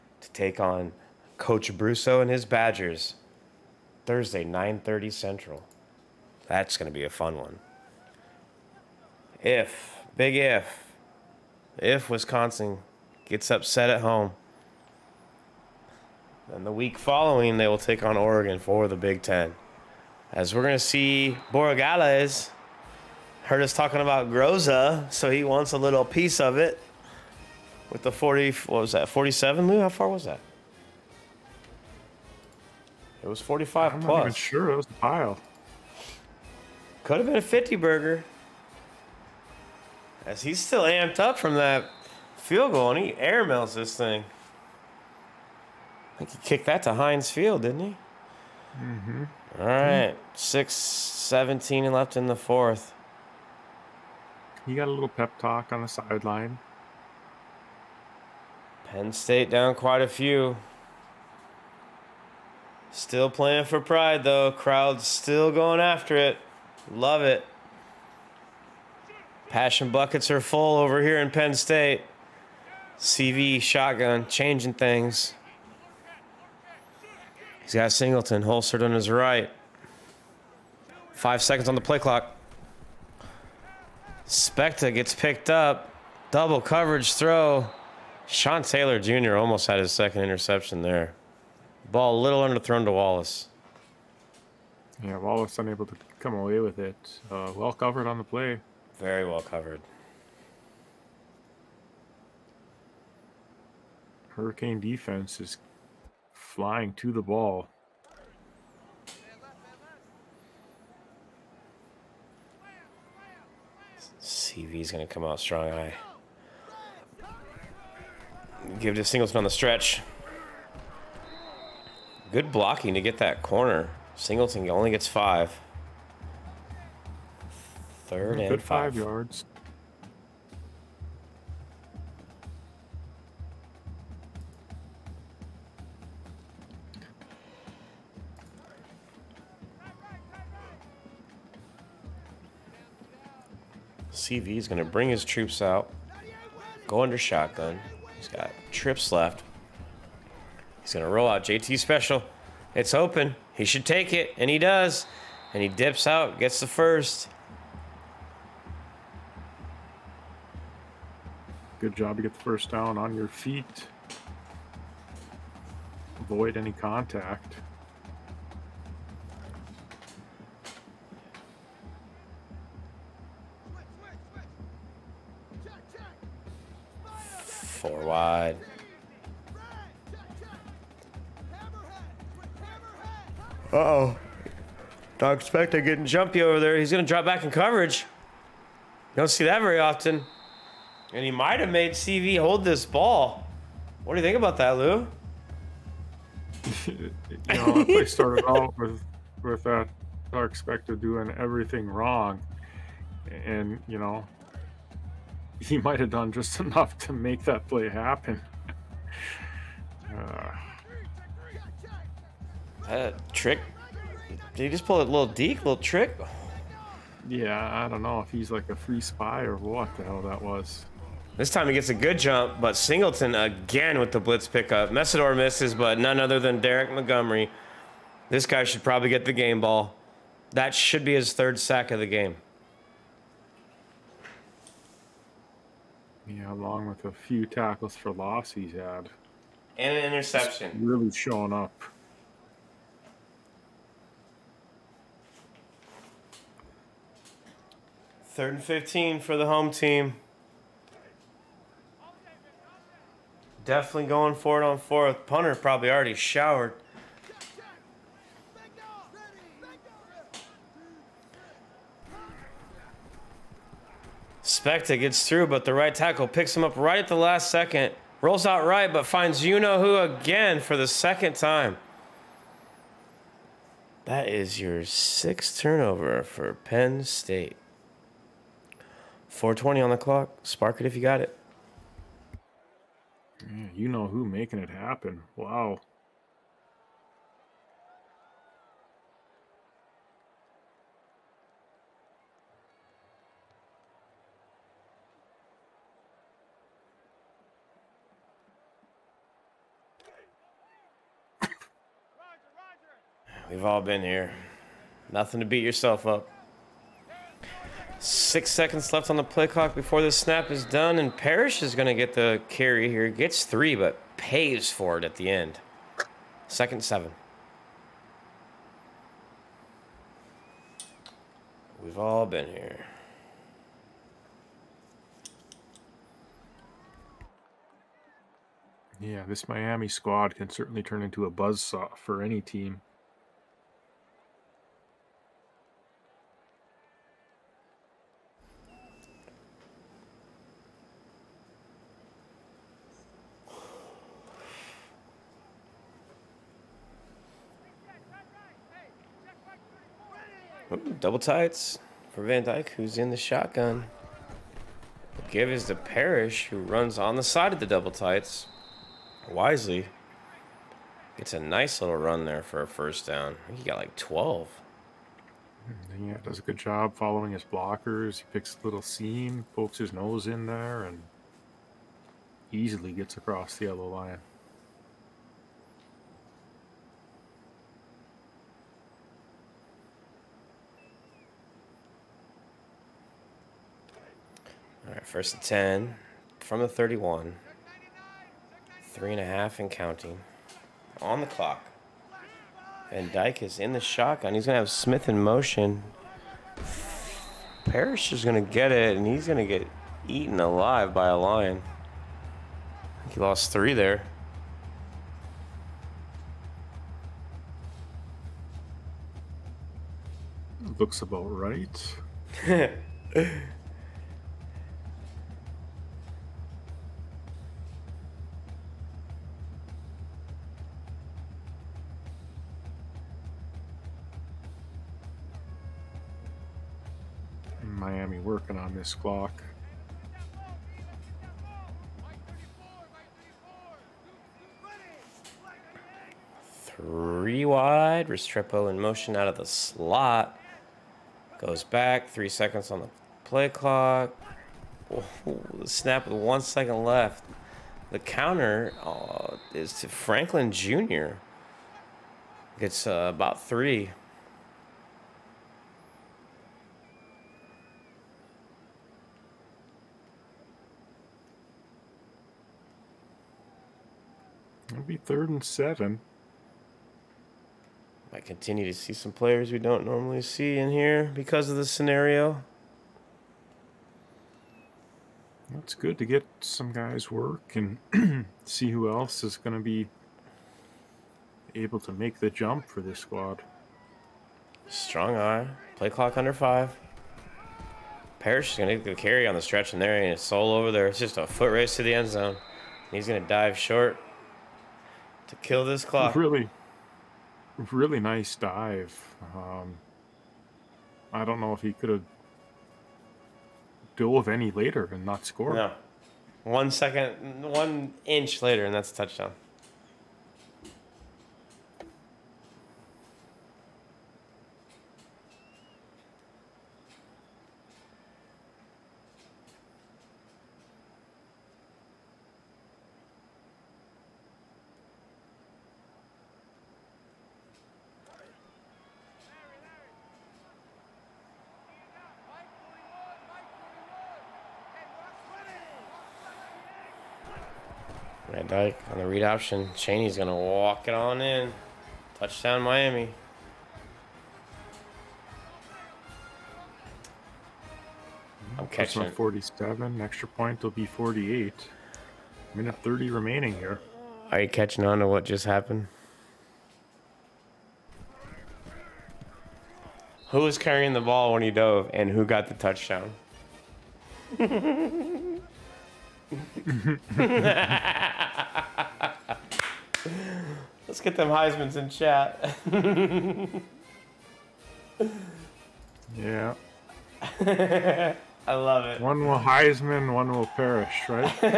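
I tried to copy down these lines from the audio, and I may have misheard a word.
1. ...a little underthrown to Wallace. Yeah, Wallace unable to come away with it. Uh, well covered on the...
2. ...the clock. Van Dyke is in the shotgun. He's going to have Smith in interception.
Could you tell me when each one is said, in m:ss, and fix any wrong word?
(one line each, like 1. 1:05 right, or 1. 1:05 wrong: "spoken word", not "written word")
1. 1:32 right
2. 6:31 wrong: "motion", not "interception".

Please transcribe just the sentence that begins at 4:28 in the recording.
Rolls out right, but finds you know who again for the second time.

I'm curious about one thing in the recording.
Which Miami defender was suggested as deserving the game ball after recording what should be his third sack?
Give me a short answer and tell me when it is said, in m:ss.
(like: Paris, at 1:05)
Derek Montgomery, at 3:46.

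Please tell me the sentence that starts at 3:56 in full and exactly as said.
Yeah, along with a few tackles for loss he's had.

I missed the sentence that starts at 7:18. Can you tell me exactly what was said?
Restrepo in motion out of the slot.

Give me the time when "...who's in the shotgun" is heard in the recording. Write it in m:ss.
5:52.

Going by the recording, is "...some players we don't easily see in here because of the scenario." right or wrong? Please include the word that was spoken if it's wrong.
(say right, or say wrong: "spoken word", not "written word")
wrong: "normally", not "easily".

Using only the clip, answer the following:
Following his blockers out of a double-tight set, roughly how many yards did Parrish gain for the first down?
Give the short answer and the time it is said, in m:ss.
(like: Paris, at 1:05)
12, at 6:03.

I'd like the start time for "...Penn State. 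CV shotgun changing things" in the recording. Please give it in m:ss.
1:11.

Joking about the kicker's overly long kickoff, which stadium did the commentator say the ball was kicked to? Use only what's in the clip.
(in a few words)
Heinz Field.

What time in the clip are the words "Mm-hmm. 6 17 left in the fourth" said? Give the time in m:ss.
0:50.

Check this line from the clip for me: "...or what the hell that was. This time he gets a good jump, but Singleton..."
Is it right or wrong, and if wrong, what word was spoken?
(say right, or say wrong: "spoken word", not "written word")
right.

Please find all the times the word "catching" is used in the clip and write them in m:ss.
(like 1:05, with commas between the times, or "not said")
9:08, 9:14.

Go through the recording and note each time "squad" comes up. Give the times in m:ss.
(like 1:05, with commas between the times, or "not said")
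5:29, 8:02.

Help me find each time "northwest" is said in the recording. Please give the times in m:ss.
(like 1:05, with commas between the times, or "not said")
not said.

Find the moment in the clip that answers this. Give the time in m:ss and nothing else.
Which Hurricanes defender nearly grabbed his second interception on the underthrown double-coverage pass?
1:28.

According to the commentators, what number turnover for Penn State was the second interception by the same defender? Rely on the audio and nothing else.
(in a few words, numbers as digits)
sixth.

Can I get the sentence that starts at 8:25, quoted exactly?
No, one second, one inch later, and that's a touchdown.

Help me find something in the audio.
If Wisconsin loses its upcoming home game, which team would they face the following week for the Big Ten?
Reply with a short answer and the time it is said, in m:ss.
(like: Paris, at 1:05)
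Oregon, at 0:18.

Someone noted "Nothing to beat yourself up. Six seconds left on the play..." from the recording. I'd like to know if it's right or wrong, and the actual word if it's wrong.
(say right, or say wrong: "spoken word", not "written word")
right.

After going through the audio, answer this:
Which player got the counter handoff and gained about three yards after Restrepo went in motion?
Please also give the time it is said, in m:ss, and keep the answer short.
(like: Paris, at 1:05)
Franklin Jr., at 7:29.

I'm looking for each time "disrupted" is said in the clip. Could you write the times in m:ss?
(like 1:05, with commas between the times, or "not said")
not said.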